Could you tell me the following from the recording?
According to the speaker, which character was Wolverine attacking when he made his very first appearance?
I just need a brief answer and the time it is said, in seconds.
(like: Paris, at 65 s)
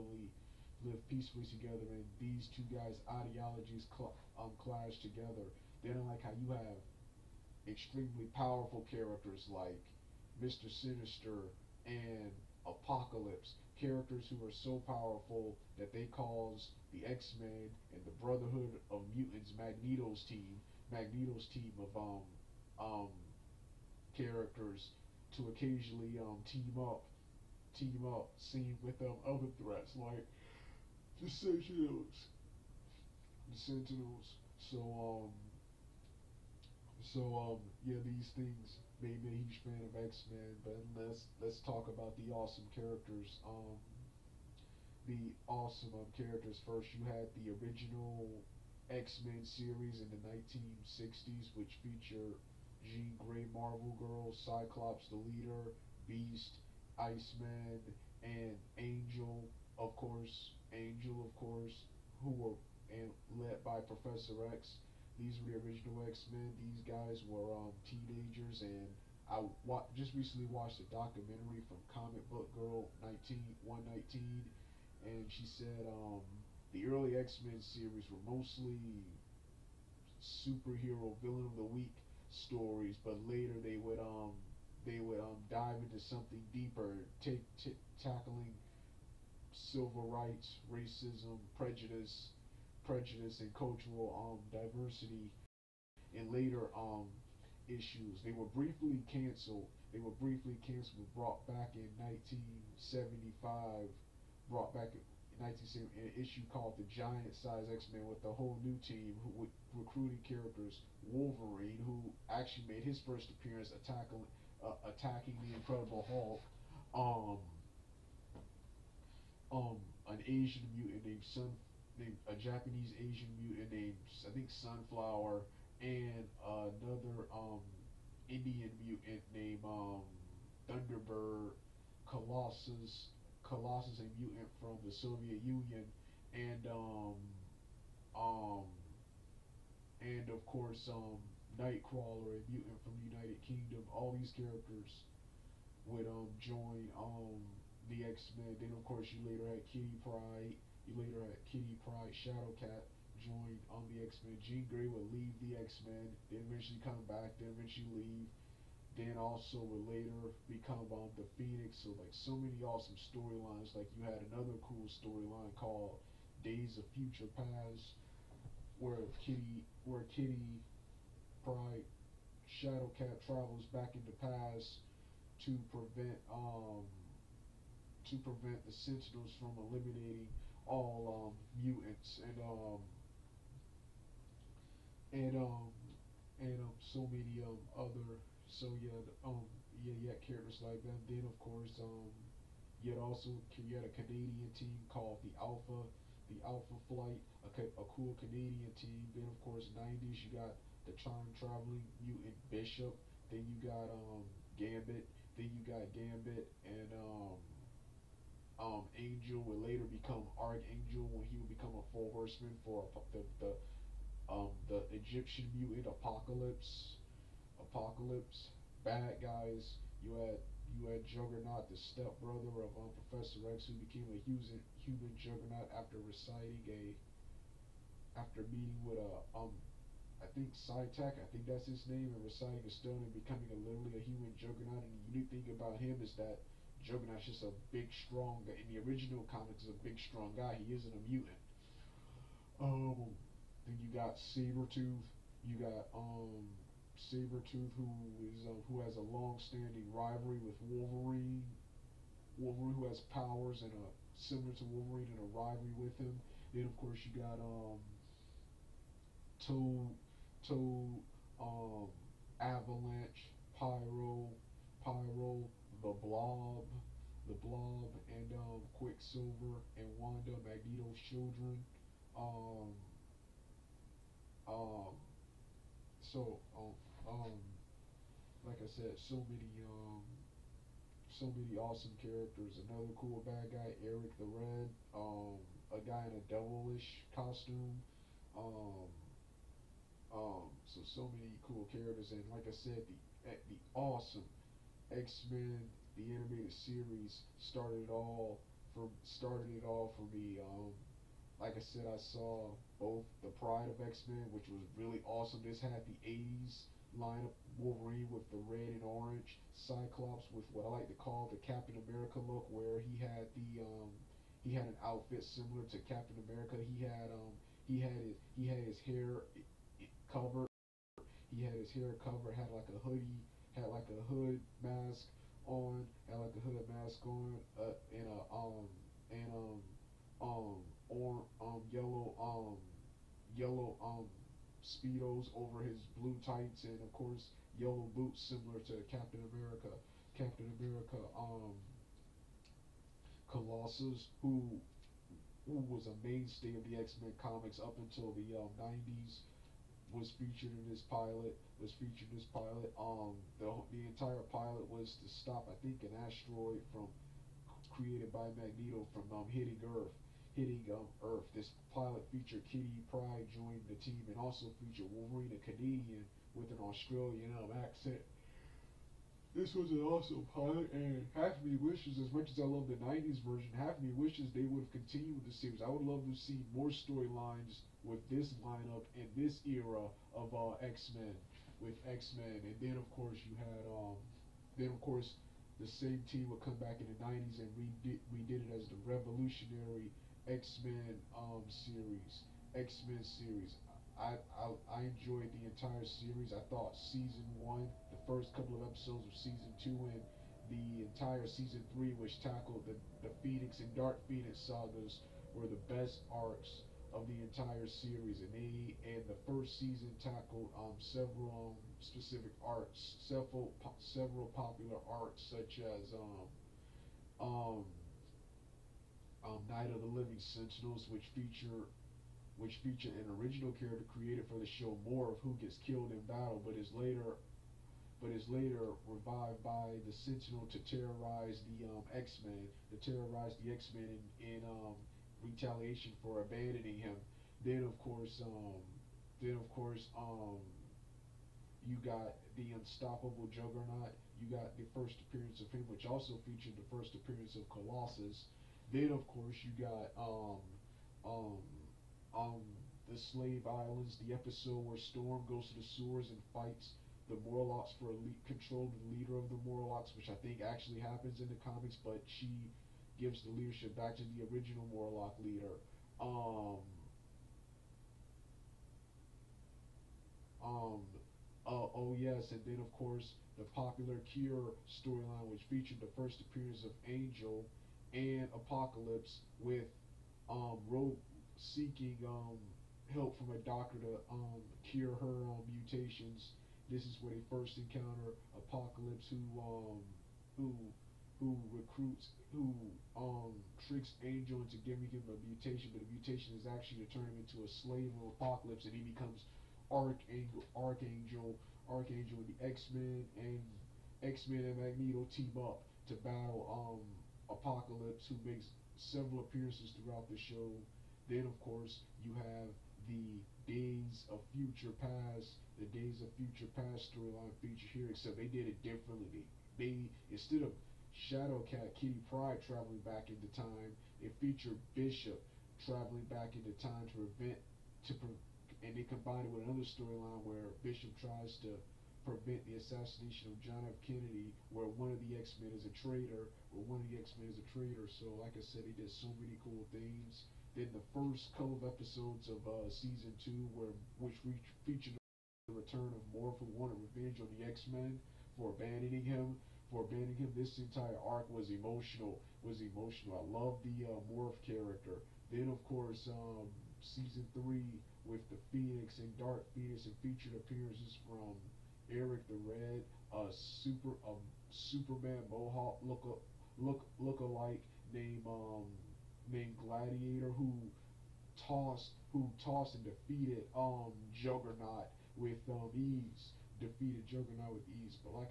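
the Incredible Hulk, at 115 s.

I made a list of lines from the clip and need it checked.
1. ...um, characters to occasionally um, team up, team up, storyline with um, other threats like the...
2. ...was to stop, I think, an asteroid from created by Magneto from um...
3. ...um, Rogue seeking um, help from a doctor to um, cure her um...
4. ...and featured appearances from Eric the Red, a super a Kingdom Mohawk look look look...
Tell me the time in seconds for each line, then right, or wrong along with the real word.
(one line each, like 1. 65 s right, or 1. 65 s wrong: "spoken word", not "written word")
1. 22 s wrong: "scene", not "storyline"
2. 354 s right
3. 480 s right
4. 559 s wrong: "Superman", not "Kingdom".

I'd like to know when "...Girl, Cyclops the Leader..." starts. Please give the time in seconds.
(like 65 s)
53 s.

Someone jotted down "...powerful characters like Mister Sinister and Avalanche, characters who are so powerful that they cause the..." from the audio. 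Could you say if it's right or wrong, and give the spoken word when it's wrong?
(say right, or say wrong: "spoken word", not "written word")
wrong: "Apocalypse", not "Avalanche".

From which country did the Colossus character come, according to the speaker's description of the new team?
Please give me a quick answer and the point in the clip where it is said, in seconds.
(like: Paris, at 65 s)
the Soviet Union, at 134 s.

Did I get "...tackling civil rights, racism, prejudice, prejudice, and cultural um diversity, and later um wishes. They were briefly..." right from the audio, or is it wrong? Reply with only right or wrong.
wrong.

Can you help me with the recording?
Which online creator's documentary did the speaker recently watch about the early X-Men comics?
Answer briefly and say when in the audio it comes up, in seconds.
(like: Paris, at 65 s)
Comic Book Girl 19, at 71 s.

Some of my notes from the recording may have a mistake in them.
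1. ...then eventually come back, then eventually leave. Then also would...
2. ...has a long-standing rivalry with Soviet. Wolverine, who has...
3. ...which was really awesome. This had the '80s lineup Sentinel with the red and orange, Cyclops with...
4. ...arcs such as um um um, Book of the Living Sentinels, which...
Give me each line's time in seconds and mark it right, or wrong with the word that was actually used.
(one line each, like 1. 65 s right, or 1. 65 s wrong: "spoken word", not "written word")
1. 156 s right
2. 248 s wrong: "Wolverine", not "Soviet"
3. 304 s wrong: "Wolverine", not "Sentinel"
4. 414 s wrong: "Night", not "Book".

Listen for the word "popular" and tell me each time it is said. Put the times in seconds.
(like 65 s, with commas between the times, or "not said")
414 s, 473 s.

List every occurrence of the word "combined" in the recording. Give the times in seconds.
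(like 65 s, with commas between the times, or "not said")
528 s.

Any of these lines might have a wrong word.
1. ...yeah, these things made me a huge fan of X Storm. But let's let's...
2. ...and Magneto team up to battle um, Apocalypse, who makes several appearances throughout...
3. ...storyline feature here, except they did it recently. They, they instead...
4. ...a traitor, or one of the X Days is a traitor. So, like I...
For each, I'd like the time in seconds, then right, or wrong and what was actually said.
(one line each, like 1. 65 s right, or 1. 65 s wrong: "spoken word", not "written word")
1. 37 s wrong: "Men", not "Storm"
2. 504 s right
3. 516 s wrong: "differently", not "recently"
4. 535 s wrong: "Men", not "Days".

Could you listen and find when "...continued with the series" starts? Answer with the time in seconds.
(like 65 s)
374 s.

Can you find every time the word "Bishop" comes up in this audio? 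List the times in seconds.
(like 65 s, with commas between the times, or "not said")
202 s, 524 s, 530 s.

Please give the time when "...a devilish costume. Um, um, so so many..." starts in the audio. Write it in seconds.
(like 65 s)
286 s.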